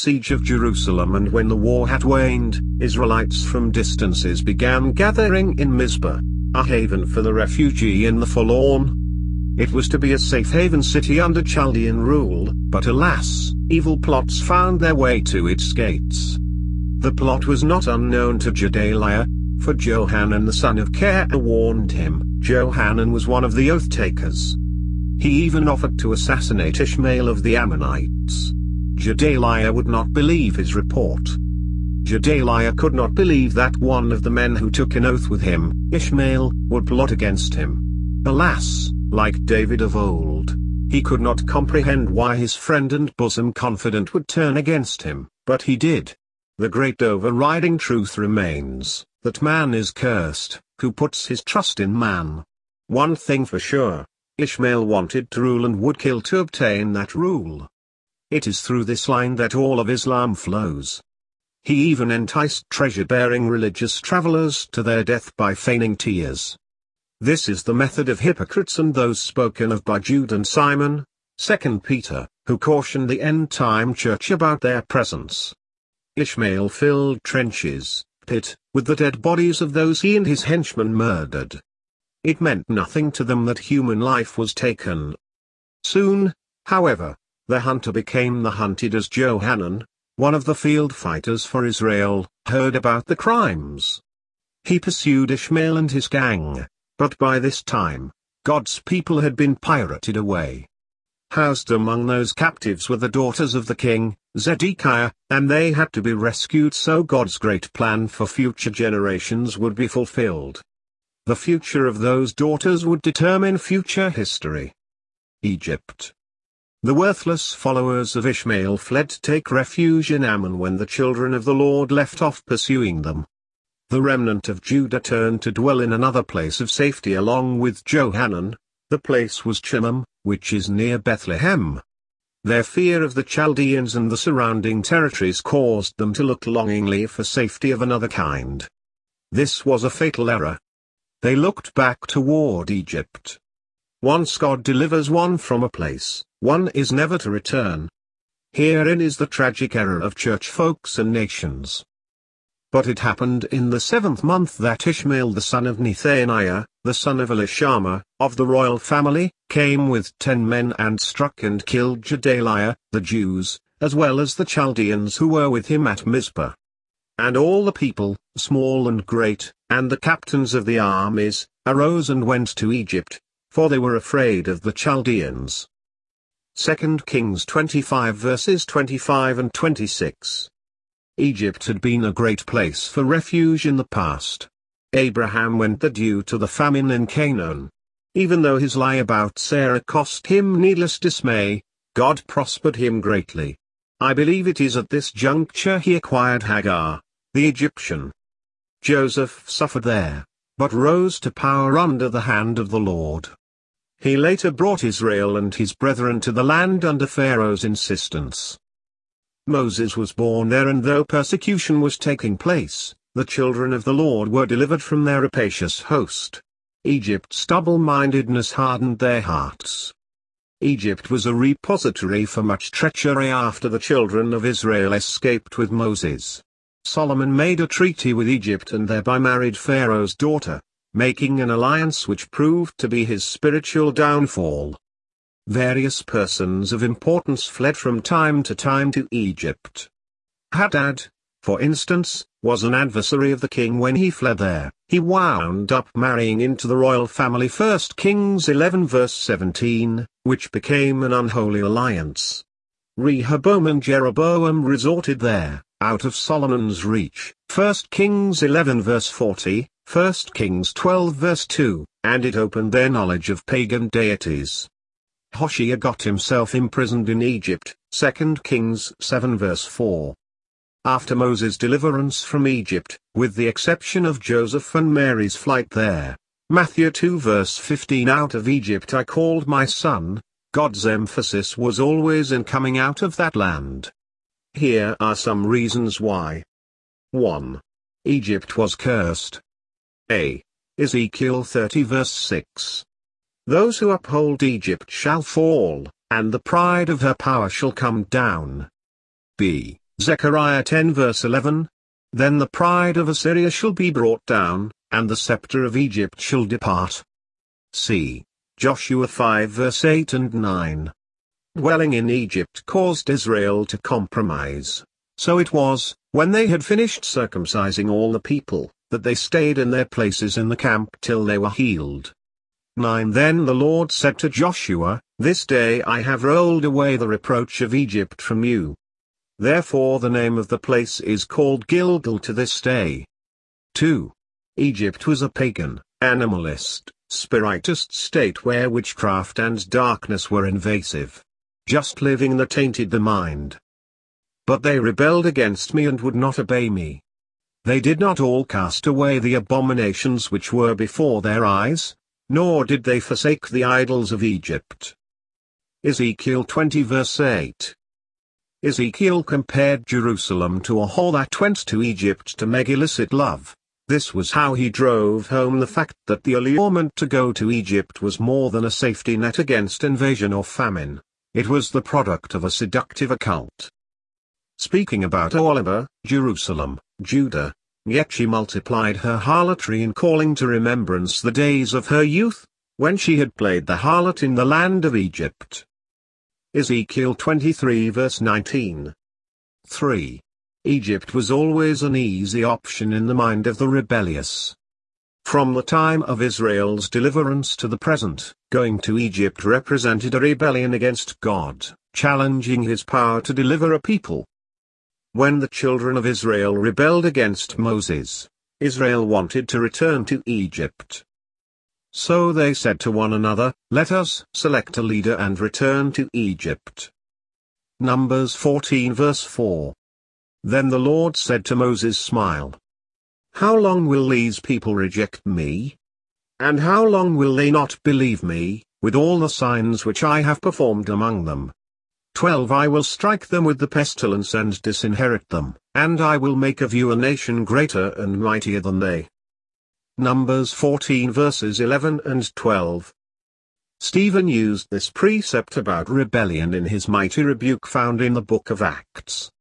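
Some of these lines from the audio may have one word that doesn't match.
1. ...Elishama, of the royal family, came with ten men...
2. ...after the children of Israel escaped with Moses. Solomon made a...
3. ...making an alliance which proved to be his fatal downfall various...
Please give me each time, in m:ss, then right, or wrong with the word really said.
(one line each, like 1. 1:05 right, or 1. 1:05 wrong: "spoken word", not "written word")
1. 2:37 right
2. 3:43 right
3. 3:50 wrong: "spiritual", not "fatal".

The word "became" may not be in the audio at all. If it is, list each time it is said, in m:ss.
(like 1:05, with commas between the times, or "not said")
1:27, 4:10.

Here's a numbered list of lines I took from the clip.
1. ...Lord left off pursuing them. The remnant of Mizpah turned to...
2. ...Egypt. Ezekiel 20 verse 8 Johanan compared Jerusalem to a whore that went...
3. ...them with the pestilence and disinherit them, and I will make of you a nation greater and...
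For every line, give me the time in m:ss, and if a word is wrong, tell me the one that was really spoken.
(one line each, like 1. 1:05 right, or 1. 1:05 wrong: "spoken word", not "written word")
1. 2:01 wrong: "Judah", not "Mizpah"
2. 5:54 wrong: "Ezekiel", not "Johanan"
3. 7:13 right.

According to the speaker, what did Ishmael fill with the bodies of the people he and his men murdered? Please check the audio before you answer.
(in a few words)
Trenches.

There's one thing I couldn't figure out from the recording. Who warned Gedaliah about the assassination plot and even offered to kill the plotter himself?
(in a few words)
Johanan the son of Care.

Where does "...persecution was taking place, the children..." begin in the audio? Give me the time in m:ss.
3:31.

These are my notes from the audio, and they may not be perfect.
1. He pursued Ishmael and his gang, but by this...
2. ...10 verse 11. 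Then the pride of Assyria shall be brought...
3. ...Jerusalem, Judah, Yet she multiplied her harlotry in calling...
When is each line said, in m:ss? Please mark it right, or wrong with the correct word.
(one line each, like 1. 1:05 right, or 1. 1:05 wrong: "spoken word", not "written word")
1. 1:34 right
2. 5:00 right
3. 6:16 right.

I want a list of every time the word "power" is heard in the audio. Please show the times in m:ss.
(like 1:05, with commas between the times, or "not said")
3:21, 4:57, 6:42.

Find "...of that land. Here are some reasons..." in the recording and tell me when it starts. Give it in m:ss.
4:43.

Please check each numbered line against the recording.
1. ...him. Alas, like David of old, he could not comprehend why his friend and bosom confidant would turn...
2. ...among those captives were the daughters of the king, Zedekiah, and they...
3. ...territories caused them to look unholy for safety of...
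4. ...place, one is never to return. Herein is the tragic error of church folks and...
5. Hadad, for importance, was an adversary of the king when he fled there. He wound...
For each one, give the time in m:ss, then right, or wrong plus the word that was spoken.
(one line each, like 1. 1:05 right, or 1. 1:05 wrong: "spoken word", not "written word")
1. 0:37 right
2. 1:41 right
3. 2:14 wrong: "longingly", not "unholy"
4. 2:25 right
5. 4:00 wrong: "instance", not "importance".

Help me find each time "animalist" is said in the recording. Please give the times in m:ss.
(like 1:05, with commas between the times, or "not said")
5:36.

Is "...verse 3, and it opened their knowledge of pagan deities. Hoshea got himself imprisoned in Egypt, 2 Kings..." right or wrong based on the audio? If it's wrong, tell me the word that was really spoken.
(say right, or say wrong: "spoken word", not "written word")
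wrong: "2", not "3".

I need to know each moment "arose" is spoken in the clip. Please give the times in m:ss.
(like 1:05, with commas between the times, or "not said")
2:51.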